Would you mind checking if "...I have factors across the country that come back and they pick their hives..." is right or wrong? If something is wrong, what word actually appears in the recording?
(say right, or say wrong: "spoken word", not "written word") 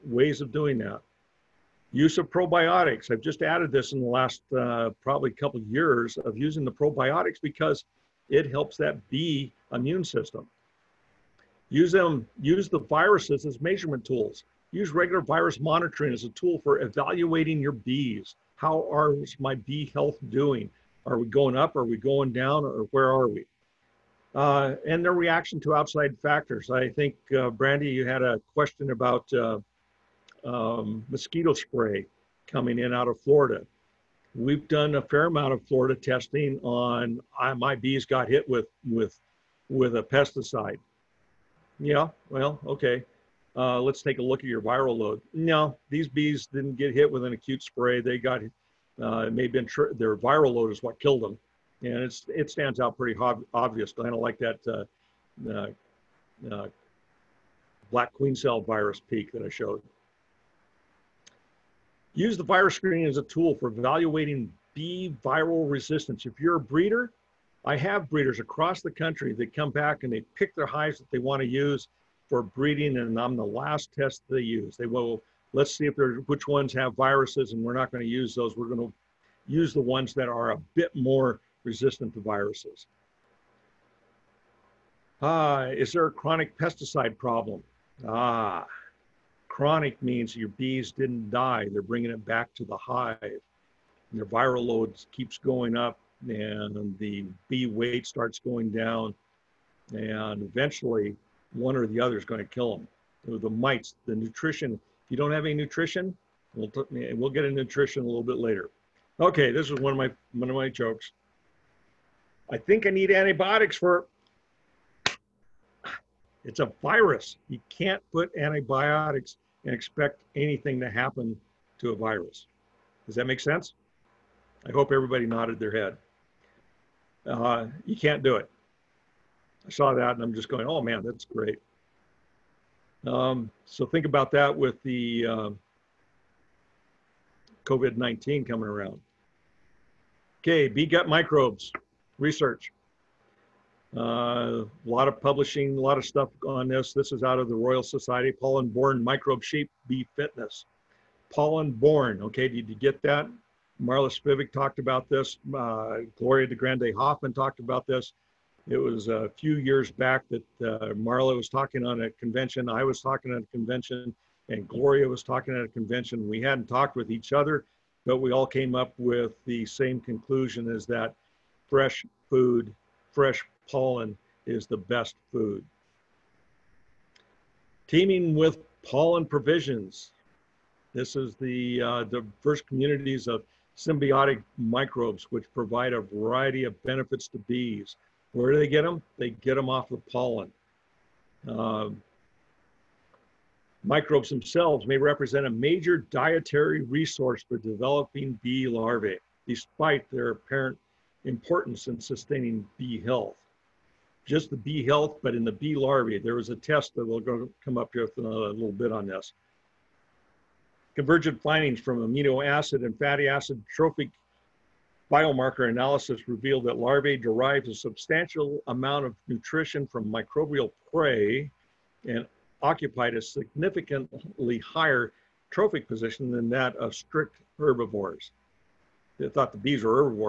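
wrong: "breeders", not "factors".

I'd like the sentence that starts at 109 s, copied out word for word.
Okay, this is one of my, one of my jokes.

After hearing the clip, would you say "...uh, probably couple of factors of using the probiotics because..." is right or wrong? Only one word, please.
wrong.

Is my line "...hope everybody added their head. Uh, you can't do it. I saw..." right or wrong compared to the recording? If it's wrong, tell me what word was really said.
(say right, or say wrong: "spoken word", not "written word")
wrong: "nodded", not "added".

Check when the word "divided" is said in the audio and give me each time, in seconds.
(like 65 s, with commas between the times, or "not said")
not said.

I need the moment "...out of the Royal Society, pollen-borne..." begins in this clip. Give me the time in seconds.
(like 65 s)
147 s.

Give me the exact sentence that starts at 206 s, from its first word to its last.
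There was a test that we'll go, come up with a little bit on this.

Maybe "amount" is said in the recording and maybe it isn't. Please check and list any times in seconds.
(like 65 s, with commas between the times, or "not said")
35 s, 218 s.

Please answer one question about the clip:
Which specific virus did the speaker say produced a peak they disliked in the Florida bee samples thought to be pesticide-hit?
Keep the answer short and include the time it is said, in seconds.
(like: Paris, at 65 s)
black queen cell virus, at 57 s.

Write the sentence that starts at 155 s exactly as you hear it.
Uh, Gloria DeGrandi-Hoffman talked about this.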